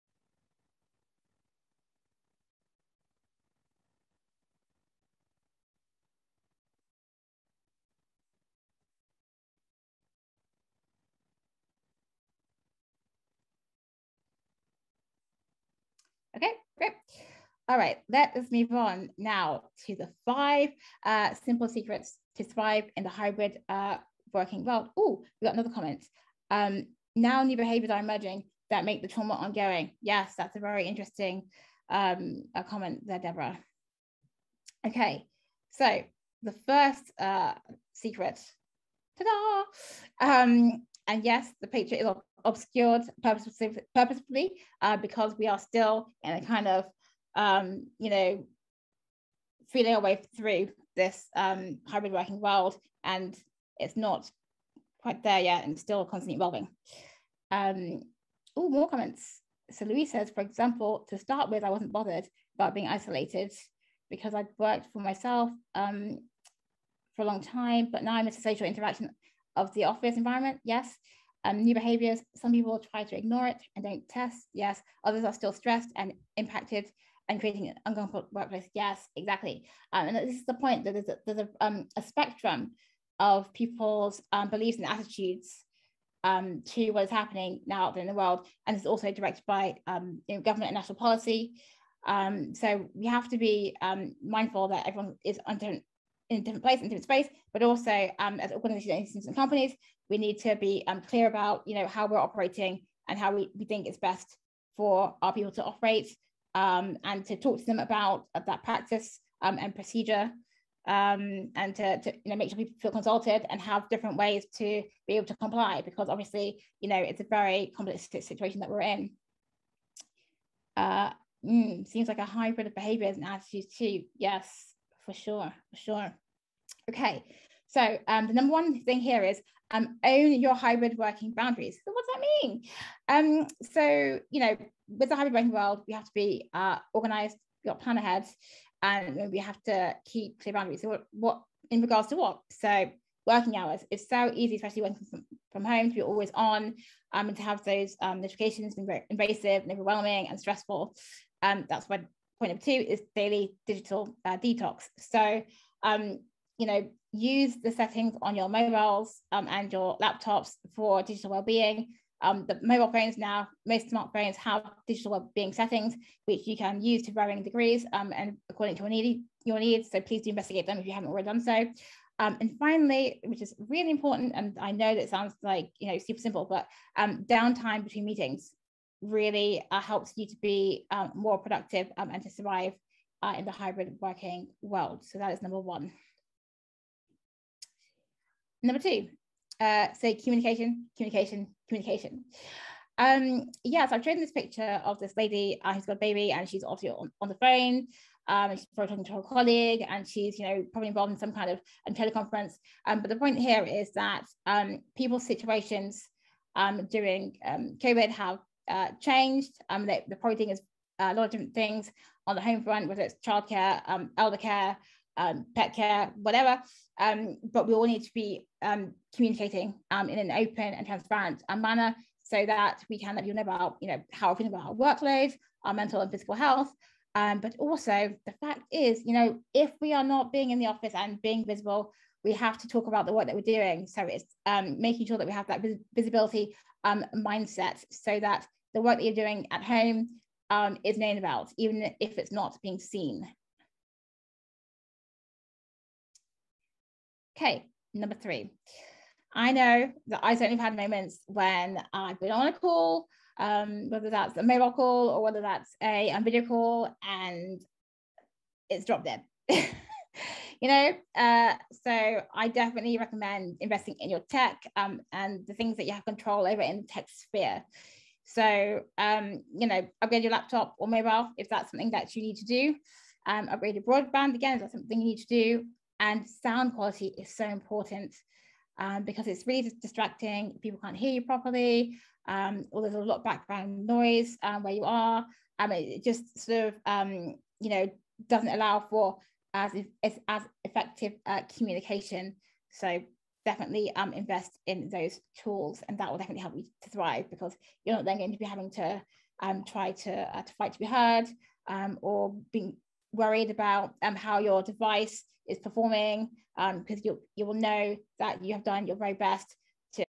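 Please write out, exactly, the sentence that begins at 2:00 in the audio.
Uh, mm, seems like a hybrid of behaviors and attitudes too.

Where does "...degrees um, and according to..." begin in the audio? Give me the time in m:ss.
2:47.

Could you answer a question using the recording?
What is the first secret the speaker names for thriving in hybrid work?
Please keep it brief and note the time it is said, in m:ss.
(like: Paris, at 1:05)
Own your hybrid working boundaries, at 2:10.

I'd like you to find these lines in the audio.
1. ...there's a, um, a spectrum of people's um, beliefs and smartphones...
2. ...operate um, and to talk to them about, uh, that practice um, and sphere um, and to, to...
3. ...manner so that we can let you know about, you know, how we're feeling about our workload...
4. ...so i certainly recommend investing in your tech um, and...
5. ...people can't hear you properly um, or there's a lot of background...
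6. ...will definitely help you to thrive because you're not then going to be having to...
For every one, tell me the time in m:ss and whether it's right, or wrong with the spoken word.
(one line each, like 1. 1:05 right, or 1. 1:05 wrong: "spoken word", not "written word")
1. 1:21 wrong: "attitudes", not "smartphones"
2. 1:45 wrong: "procedure", not "sphere"
3. 3:41 right
4. 4:21 wrong: "definitely", not "certainly"
5. 4:40 right
6. 4:56 right.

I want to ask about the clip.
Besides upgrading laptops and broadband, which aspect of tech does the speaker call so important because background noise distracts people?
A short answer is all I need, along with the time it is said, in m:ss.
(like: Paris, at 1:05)
Sound quality, at 4:36.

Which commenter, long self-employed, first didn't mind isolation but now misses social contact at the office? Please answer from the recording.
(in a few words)
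Louise.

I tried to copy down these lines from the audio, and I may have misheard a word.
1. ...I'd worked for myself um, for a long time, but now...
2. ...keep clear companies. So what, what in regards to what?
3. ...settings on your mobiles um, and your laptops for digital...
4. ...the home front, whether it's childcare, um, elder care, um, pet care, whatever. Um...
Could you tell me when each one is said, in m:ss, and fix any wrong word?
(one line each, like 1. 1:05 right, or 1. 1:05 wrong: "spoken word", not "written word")
1. 1:04 right
2. 2:20 wrong: "boundaries", not "companies"
3. 2:37 right
4. 3:32 right.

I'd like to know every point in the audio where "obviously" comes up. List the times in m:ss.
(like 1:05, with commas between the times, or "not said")
1:56, 3:16.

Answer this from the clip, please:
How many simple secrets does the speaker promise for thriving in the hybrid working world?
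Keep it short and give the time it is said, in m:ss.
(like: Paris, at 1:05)
5, at 0:20.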